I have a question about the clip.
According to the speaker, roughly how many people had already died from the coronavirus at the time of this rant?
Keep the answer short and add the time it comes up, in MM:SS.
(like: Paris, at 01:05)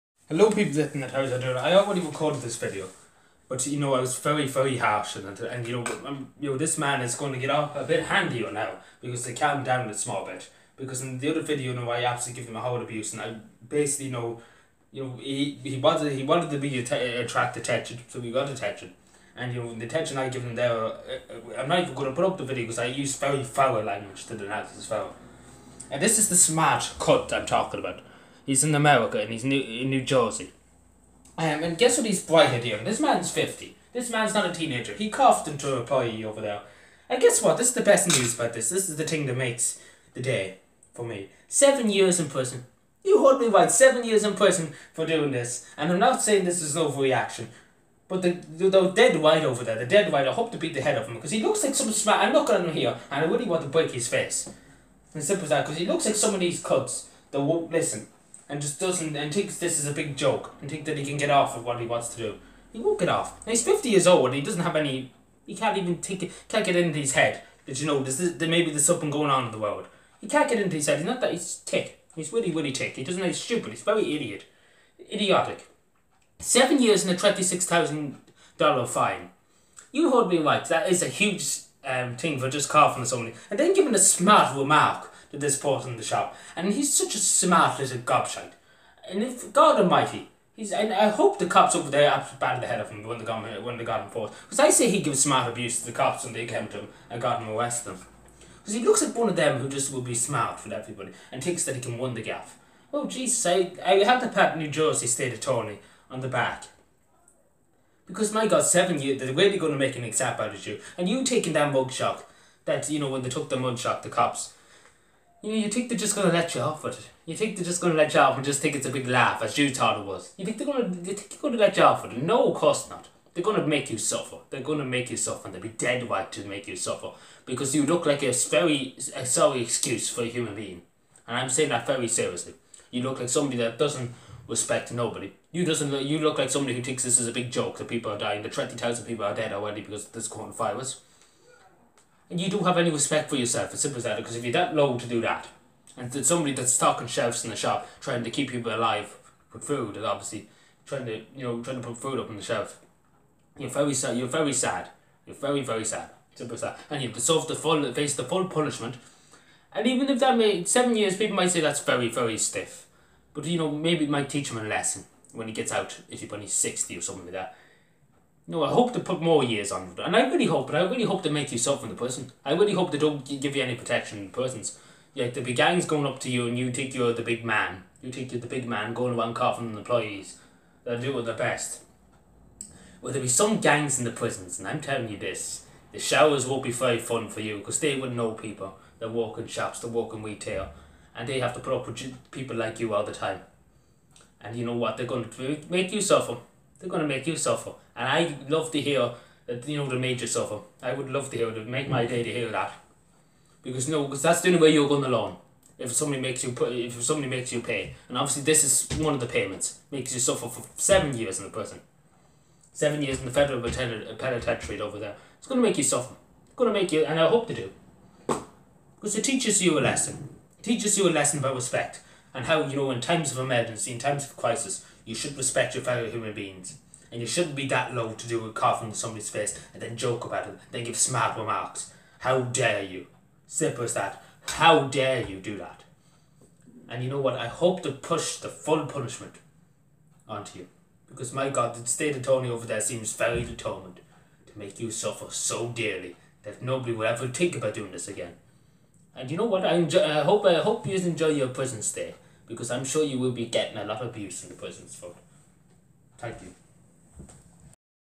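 20,000, at 02:18.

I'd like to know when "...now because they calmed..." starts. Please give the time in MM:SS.
00:08.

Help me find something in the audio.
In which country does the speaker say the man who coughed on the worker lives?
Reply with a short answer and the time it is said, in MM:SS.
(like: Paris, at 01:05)
America, at 00:28.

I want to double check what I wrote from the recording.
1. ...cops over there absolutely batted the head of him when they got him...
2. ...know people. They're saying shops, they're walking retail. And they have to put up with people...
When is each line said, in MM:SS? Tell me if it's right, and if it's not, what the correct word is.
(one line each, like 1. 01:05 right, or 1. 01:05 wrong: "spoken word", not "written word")
1. 01:31 right
2. 03:08 wrong: "walking", not "saying".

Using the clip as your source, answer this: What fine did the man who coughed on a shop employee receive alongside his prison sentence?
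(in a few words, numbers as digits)
$26,000.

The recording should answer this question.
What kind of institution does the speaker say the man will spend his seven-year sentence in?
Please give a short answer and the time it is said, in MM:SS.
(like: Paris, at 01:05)
federal penitentiary, at 03:33.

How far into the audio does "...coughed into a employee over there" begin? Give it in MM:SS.
00:35.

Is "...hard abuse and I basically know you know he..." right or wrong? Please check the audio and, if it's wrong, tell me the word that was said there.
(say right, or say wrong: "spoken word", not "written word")
right.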